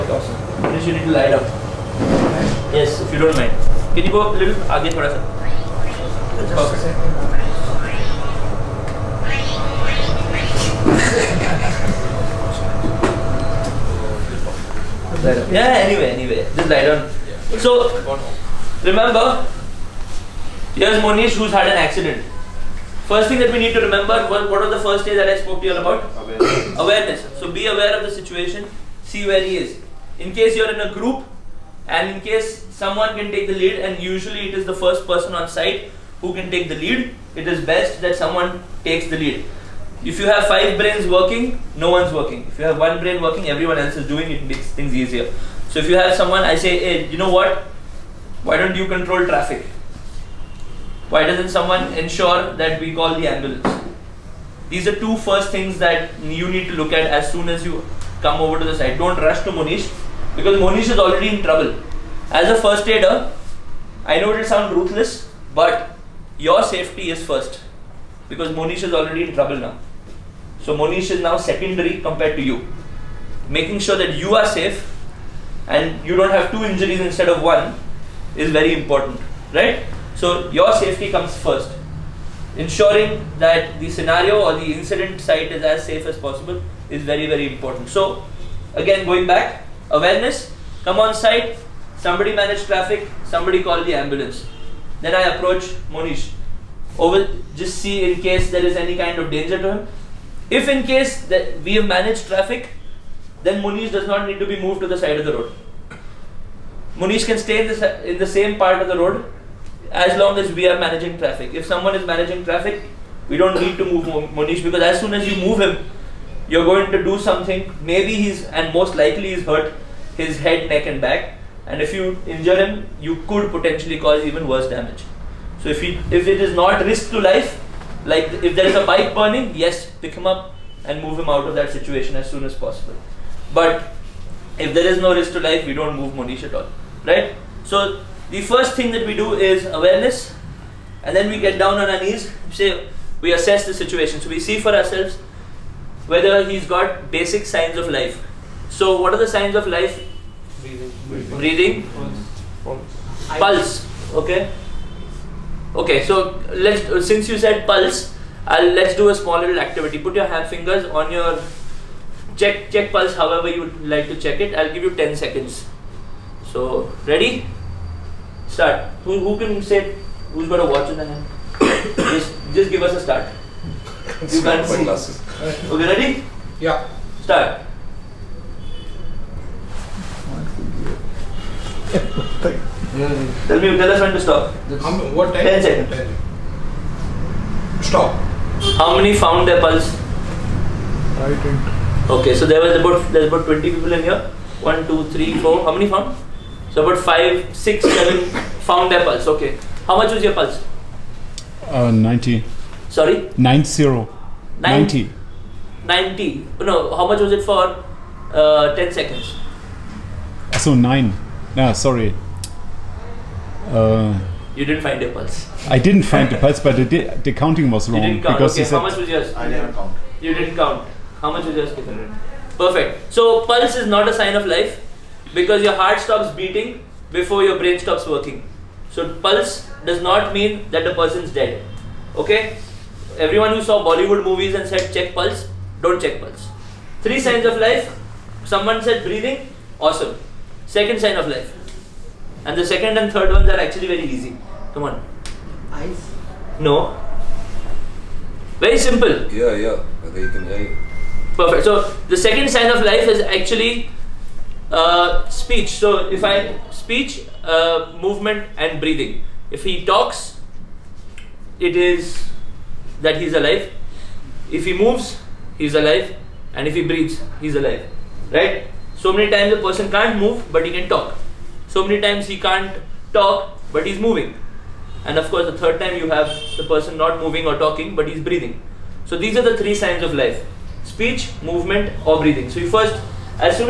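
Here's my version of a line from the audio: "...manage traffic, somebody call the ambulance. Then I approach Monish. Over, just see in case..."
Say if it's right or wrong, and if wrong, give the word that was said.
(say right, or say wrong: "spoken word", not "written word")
right.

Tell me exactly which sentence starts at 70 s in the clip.
So Monish is now secondary compared to you.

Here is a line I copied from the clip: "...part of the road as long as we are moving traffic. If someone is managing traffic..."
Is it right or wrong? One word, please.
wrong.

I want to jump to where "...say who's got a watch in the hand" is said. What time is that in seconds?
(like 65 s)
169 s.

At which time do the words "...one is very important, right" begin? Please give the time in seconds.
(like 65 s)
77 s.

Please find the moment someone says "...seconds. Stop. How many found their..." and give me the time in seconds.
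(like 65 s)
185 s.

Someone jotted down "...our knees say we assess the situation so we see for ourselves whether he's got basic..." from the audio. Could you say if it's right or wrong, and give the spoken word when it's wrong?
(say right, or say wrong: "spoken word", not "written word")
right.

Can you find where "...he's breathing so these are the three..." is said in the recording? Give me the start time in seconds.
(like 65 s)
278 s.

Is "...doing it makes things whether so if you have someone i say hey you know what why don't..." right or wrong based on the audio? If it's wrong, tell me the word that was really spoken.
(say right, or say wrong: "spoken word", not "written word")
wrong: "easier", not "whether".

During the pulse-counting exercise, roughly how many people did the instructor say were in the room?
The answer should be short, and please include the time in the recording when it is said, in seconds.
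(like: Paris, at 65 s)
20, at 193 s.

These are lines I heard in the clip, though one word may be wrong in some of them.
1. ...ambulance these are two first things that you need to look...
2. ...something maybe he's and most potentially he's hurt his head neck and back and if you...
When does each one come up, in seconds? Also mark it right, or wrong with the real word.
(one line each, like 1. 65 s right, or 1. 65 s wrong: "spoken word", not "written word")
1. 53 s right
2. 117 s wrong: "likely", not "potentially".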